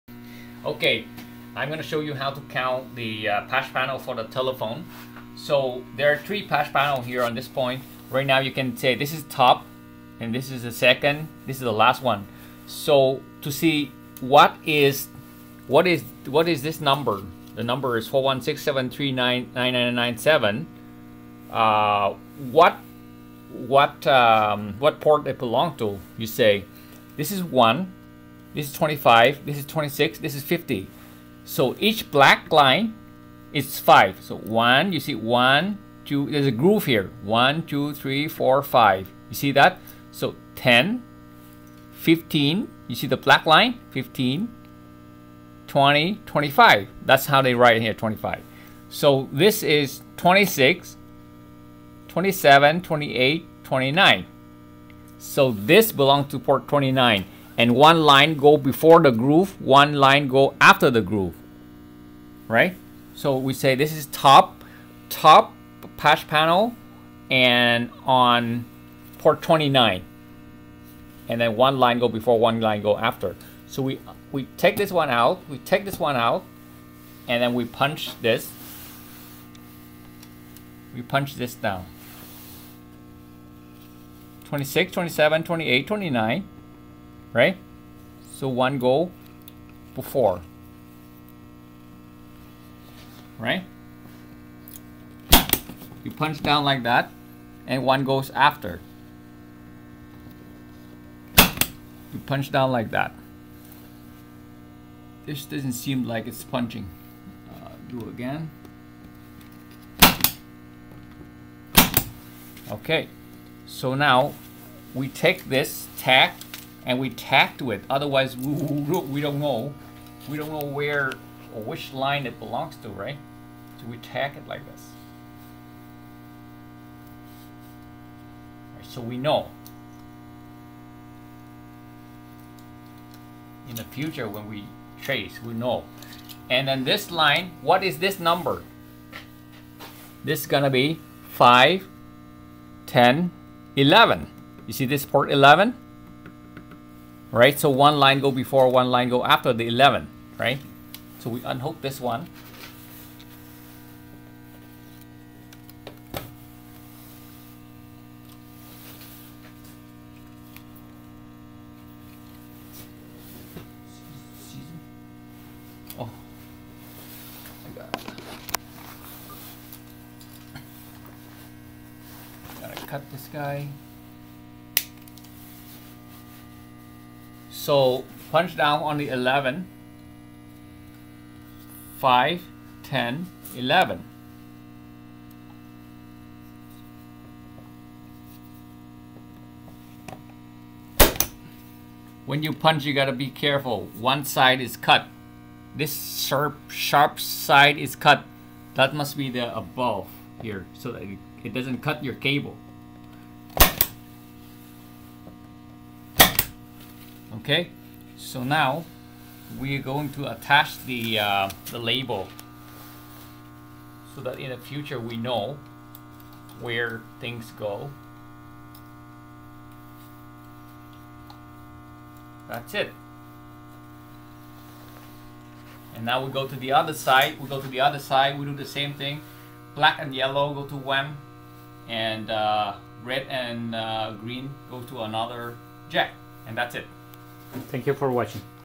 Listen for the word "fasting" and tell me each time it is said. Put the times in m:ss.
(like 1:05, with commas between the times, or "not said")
not said.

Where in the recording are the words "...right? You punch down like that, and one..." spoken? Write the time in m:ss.
1:33.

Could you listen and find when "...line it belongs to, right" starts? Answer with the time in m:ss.
2:01.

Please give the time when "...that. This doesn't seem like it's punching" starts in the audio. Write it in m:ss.
1:42.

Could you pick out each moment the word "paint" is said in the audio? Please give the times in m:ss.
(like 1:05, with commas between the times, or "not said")
not said.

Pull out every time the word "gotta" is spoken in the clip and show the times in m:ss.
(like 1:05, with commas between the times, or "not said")
2:52, 3:12.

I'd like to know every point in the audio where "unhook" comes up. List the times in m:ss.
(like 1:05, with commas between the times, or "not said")
2:31.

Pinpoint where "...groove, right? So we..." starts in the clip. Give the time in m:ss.
1:01.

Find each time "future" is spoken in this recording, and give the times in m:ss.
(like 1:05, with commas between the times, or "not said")
2:13, 3:34.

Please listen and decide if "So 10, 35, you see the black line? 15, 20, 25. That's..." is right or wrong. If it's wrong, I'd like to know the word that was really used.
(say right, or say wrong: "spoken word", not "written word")
wrong: "15", not "35".